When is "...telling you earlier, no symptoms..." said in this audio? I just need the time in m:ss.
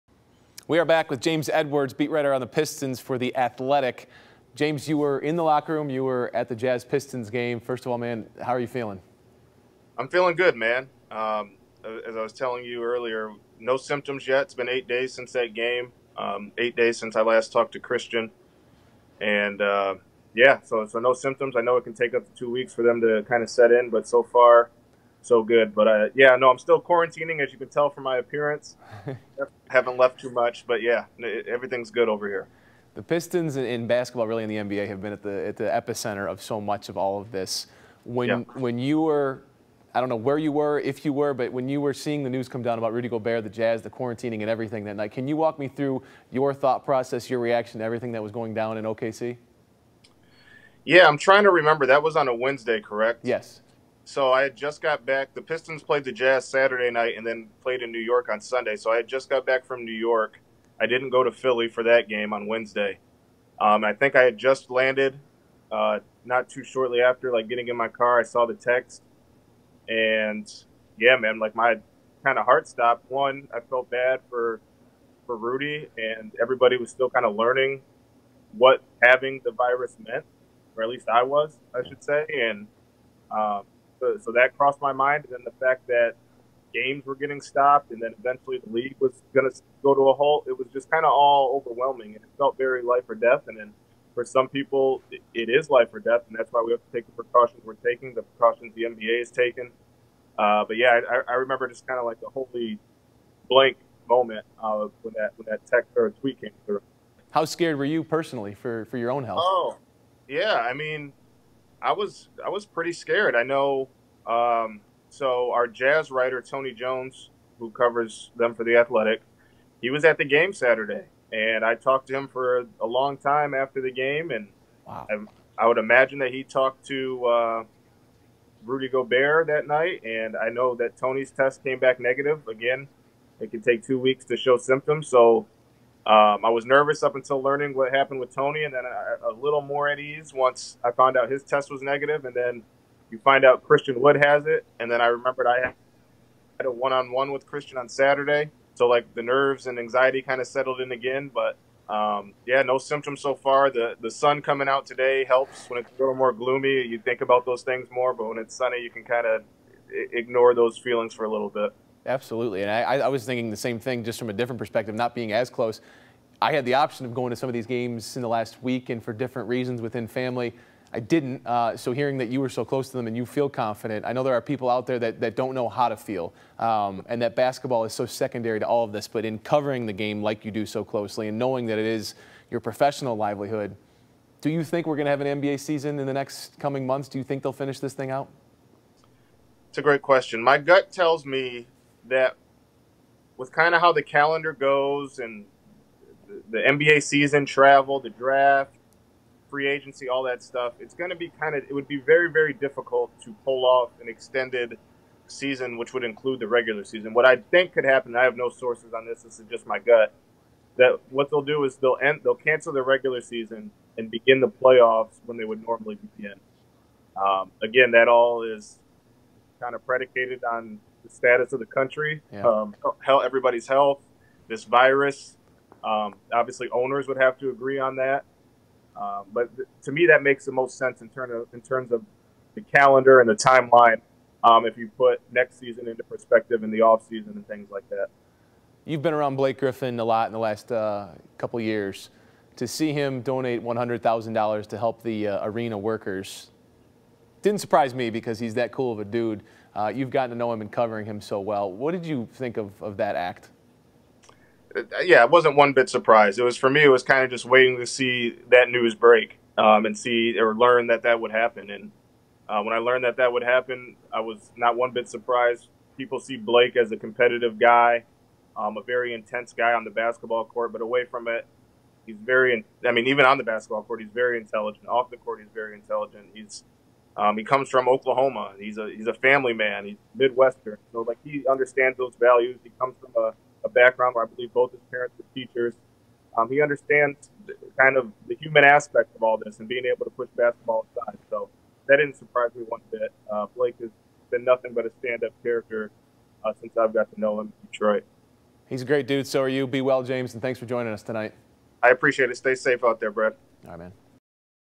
0:12.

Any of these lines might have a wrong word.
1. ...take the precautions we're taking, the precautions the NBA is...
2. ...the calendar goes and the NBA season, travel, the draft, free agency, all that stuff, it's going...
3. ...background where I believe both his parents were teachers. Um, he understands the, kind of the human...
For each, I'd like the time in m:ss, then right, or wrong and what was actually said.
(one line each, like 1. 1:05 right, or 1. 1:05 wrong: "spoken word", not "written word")
1. 1:36 right
2. 3:13 right
3. 4:43 right.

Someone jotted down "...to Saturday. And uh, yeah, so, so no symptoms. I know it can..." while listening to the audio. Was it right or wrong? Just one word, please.
wrong.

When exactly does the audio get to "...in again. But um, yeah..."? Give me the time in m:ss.
2:30.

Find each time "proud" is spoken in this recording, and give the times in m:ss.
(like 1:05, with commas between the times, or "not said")
not said.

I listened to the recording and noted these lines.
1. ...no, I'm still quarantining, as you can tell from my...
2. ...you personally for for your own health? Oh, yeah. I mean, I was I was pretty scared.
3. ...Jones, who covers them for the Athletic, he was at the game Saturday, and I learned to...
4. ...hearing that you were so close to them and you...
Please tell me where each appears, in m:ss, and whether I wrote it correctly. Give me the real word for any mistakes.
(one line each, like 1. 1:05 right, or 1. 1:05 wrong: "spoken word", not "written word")
1. 0:26 right
2. 1:47 right
3. 1:56 wrong: "talked", not "learned"
4. 2:51 right.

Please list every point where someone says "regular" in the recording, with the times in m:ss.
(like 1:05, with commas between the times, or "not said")
3:26, 3:32.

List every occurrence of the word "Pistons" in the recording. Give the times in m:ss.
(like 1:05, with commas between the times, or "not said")
0:02, 0:06, 0:33, 0:55.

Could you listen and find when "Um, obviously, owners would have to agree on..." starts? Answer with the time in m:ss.
3:45.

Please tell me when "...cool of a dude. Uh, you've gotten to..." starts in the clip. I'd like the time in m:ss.
4:08.